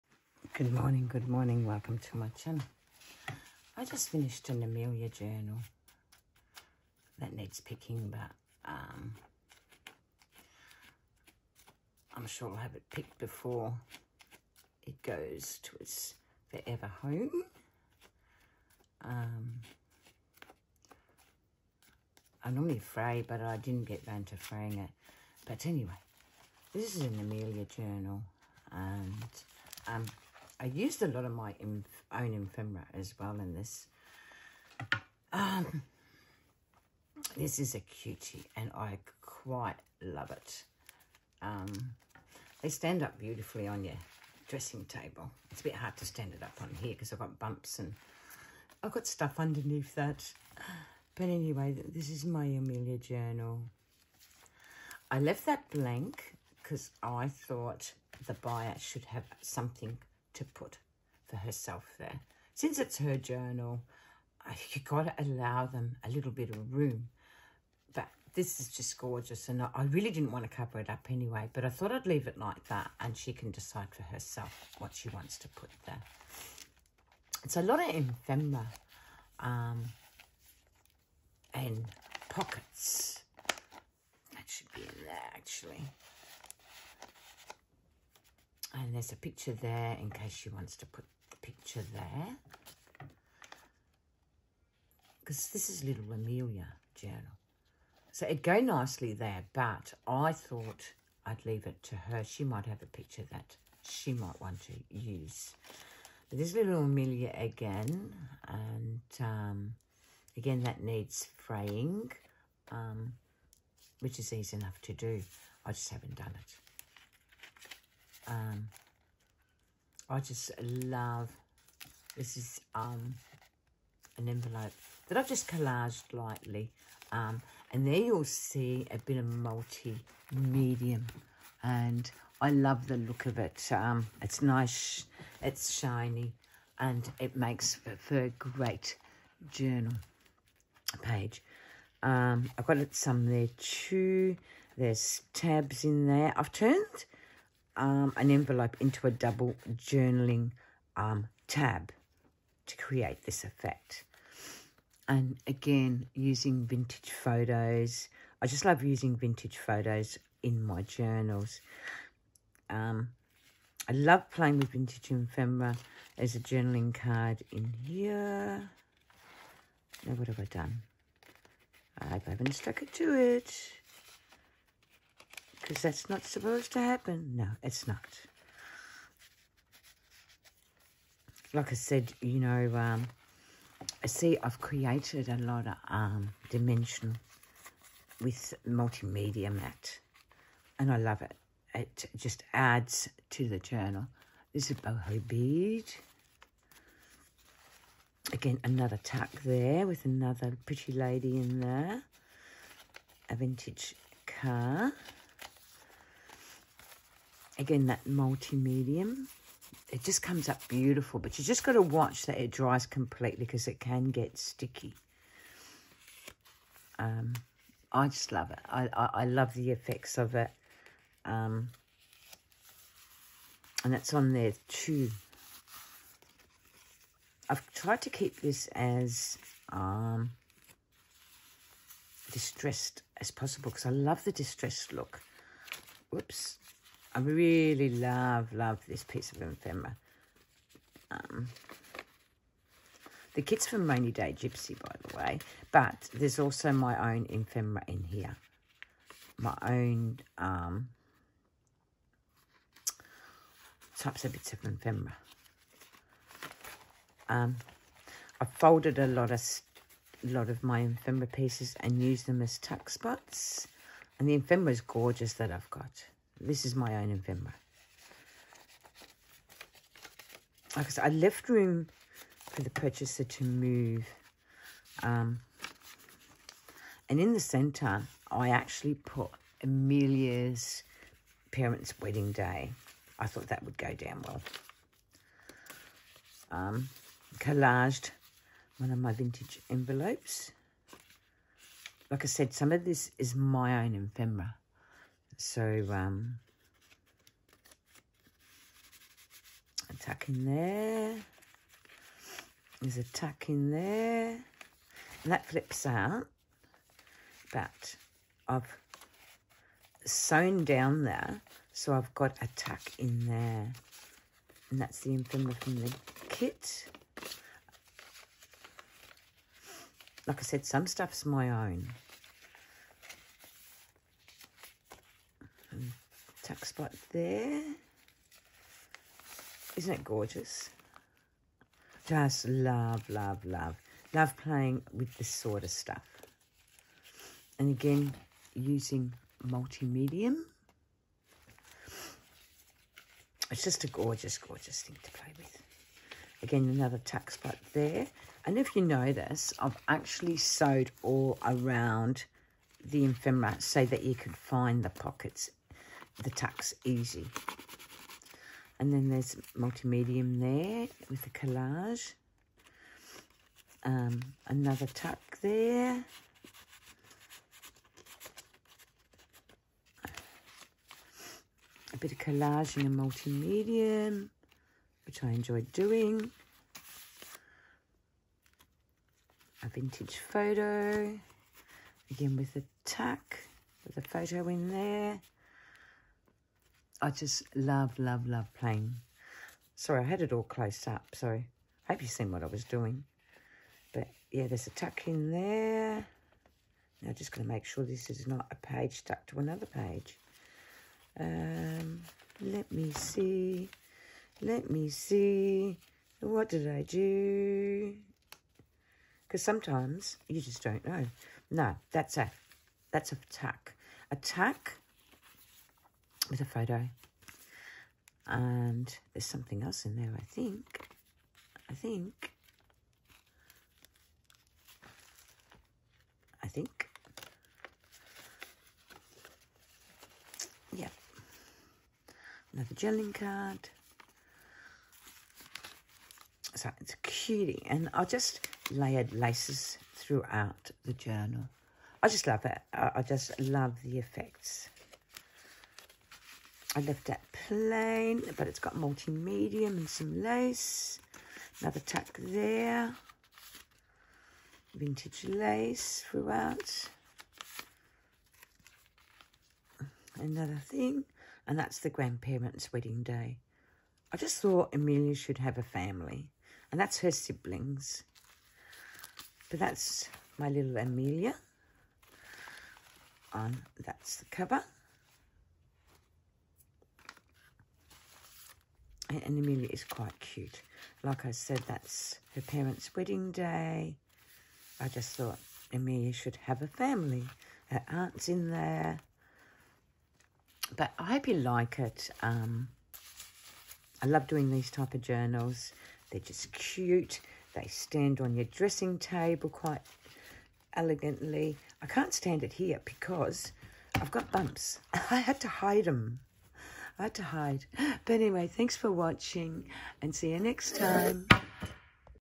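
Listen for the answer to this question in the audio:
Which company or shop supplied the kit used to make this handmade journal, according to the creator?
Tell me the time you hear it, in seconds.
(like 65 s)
243 s.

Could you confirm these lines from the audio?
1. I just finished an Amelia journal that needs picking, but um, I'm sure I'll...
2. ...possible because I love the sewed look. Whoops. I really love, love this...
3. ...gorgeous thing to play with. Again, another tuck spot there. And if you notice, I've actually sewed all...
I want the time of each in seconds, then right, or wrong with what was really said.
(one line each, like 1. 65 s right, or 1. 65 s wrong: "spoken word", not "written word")
1. 3 s right
2. 233 s wrong: "distressed", not "sewed"
3. 344 s right.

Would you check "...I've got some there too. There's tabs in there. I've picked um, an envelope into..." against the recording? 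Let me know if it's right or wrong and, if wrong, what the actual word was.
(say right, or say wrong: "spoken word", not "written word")
wrong: "turned", not "picked".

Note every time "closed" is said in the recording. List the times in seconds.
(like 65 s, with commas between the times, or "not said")
390 s.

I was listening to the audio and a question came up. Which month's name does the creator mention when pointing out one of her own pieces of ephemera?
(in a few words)
November.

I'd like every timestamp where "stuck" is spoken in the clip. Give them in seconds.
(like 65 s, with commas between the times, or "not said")
172 s, 398 s.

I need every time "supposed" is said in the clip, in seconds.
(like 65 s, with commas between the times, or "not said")
176 s.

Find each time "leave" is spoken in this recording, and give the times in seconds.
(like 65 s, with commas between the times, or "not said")
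72 s, 101 s.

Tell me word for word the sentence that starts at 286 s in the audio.
Um, collaged one of my vintage envelopes.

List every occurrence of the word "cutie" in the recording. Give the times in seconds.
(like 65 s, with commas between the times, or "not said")
37 s, 437 s.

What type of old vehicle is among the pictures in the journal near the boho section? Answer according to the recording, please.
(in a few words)
Vintage car.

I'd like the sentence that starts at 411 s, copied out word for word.
No, that's a, that's a tuck.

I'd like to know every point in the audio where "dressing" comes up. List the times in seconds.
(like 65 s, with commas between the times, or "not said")
44 s, 498 s.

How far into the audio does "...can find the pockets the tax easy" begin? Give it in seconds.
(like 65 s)
354 s.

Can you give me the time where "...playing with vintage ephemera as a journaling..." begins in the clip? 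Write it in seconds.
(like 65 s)
164 s.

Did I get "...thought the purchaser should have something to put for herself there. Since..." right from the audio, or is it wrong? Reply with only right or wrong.
wrong.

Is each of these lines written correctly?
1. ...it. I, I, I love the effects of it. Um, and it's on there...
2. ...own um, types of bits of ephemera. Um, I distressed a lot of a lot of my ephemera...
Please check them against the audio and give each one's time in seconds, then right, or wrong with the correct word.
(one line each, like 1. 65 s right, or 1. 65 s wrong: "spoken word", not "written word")
1. 218 s right
2. 249 s wrong: "folded", not "distressed".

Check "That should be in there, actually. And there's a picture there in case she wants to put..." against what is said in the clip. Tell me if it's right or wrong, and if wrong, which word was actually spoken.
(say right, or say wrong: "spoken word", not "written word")
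right.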